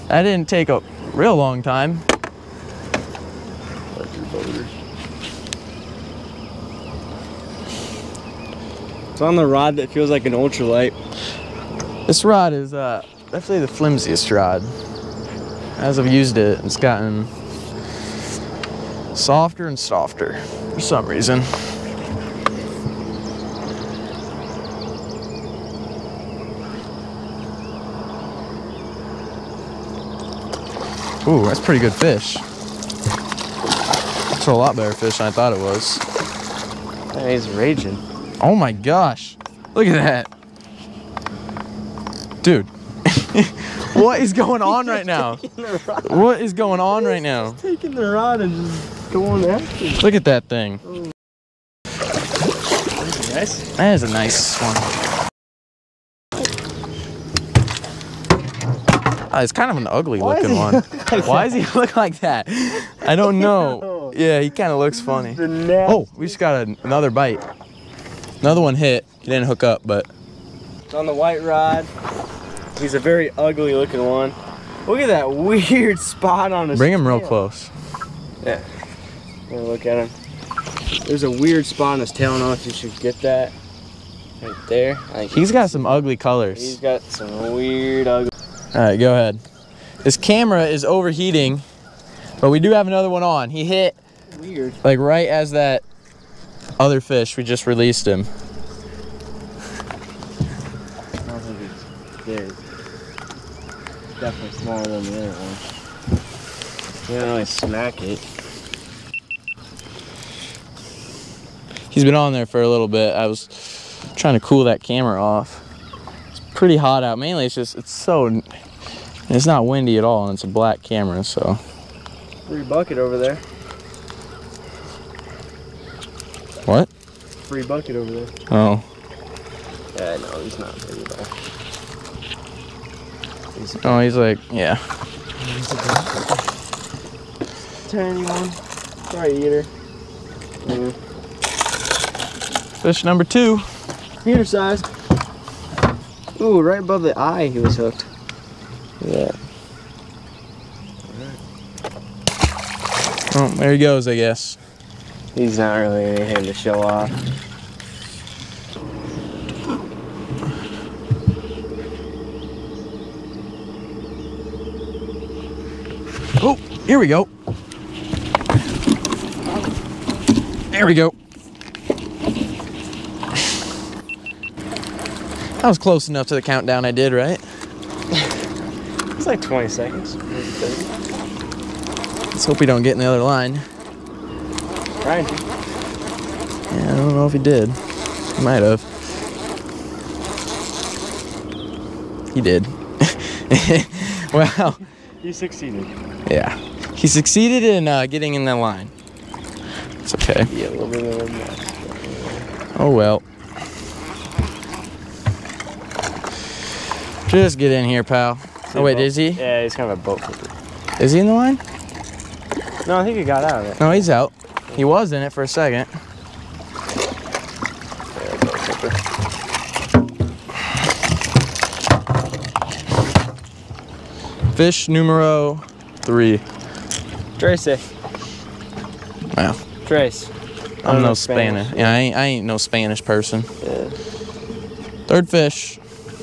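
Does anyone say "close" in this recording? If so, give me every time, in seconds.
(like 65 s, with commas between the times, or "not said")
77 s, 175 s.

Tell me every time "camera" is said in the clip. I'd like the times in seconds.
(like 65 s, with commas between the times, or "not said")
90 s, 114 s, 120 s.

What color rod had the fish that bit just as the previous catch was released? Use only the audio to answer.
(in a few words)
white.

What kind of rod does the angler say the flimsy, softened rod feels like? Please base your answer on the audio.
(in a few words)
ultralight.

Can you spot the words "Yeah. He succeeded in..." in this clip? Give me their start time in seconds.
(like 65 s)
196 s.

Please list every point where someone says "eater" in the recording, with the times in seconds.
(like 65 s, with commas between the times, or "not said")
139 s, 144 s.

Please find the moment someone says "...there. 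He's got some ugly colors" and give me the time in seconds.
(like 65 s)
84 s.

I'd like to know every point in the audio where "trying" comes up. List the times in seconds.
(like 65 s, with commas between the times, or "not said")
114 s.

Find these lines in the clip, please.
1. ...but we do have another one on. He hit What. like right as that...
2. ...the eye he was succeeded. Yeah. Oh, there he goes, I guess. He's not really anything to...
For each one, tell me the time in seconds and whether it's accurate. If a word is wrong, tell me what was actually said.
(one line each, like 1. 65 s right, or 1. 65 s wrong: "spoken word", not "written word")
1. 92 s wrong: "Weird", not "What"
2. 147 s wrong: "hooked", not "succeeded".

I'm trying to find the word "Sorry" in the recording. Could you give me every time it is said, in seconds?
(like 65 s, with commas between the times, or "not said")
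139 s.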